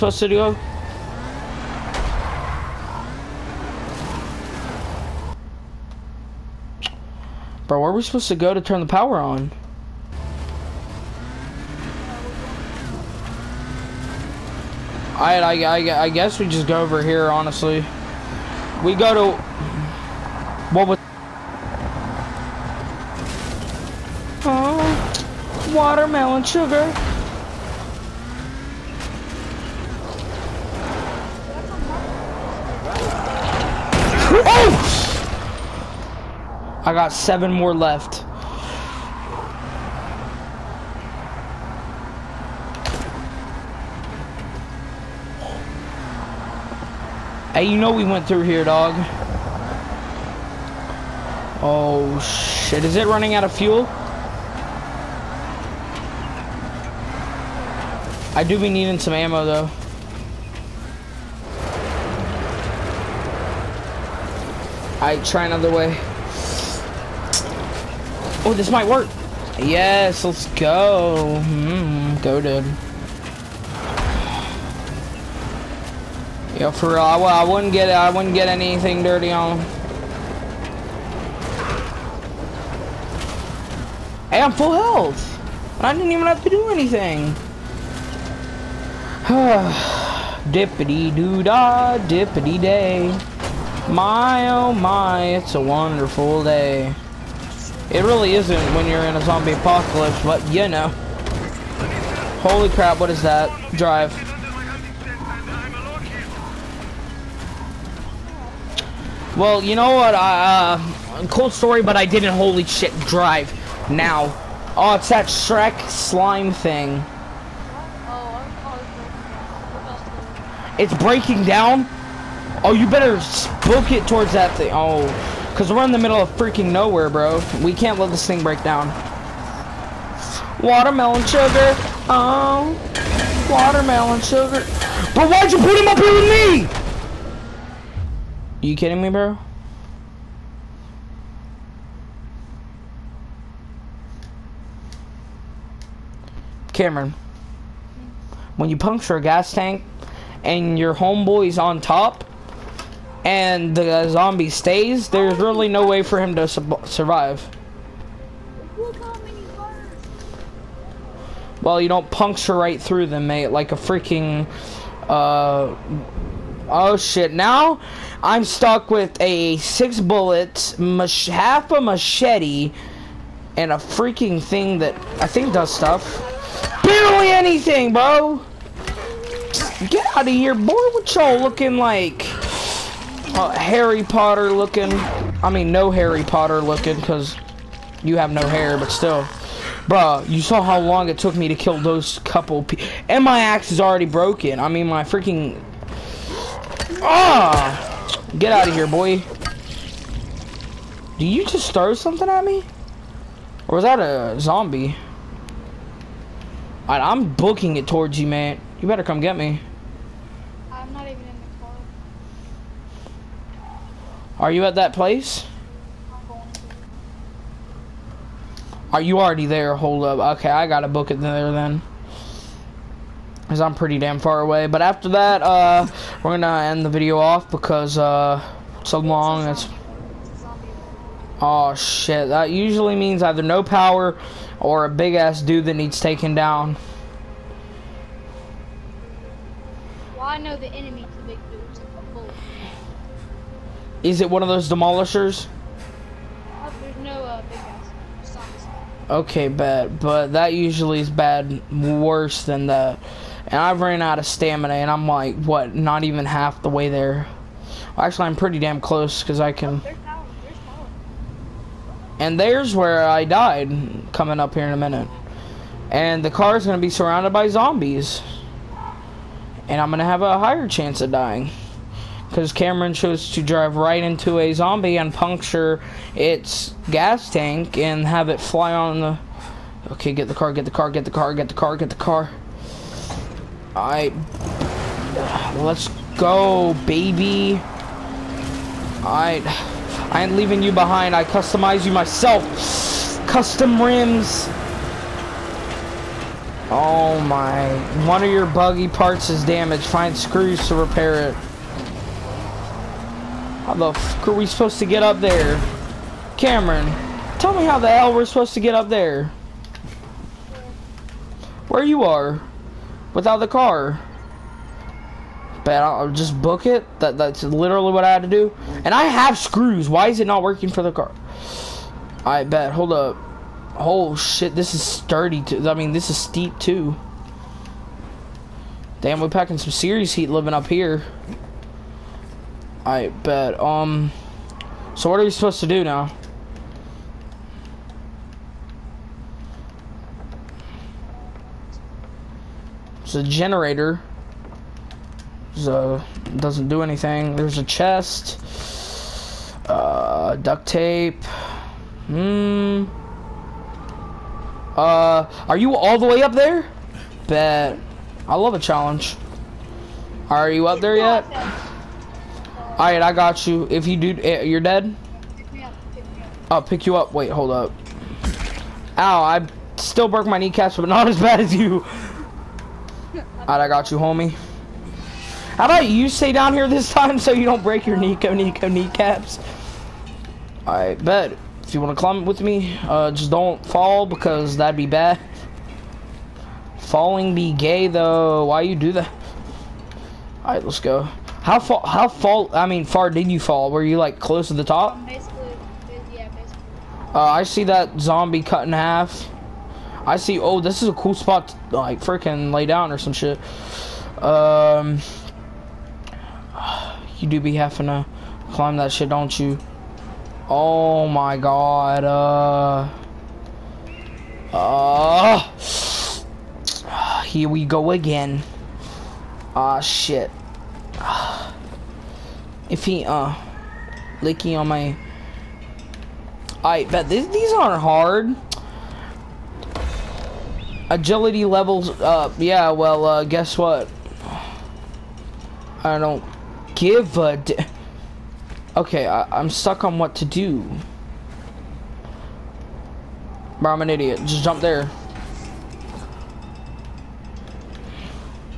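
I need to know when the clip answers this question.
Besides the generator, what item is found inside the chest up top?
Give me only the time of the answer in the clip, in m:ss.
5:50.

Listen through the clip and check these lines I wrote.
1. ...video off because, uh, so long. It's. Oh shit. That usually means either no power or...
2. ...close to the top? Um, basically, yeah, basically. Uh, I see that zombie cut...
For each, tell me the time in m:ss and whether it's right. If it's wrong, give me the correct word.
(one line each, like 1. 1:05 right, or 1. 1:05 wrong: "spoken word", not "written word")
1. 3:46 right
2. 6:34 right.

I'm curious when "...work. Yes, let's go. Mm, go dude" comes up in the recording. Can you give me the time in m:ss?
1:08.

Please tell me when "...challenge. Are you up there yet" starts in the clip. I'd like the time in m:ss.
5:58.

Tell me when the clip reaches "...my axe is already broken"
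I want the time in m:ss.
3:13.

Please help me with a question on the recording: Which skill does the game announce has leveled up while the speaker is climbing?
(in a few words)
Agility.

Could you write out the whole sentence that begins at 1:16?
I, I wouldn't get I wouldn't get anything dirty on.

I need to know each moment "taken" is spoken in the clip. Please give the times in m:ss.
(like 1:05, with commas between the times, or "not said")
3:55.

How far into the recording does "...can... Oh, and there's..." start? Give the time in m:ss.
4:19.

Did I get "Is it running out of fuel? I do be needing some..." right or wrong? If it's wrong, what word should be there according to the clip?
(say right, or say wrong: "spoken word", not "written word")
right.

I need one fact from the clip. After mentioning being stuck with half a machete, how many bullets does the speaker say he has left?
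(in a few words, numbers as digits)
6.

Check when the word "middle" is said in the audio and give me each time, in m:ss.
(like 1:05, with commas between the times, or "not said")
2:05.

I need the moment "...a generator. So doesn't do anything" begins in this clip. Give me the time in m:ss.
5:43.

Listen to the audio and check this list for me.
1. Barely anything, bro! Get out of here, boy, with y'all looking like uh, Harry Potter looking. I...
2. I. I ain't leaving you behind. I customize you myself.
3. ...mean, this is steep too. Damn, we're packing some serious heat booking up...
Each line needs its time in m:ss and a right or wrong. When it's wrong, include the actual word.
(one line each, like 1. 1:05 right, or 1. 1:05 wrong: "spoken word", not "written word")
1. 2:56 right
2. 4:49 right
3. 5:25 wrong: "living", not "booking".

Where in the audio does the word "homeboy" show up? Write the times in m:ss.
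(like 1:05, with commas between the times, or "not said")
2:30.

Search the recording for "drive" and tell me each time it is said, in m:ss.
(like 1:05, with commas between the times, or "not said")
1:43, 1:52, 4:33.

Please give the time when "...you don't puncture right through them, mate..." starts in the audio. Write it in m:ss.
2:41.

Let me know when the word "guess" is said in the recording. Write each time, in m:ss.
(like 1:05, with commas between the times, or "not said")
0:16, 7:13.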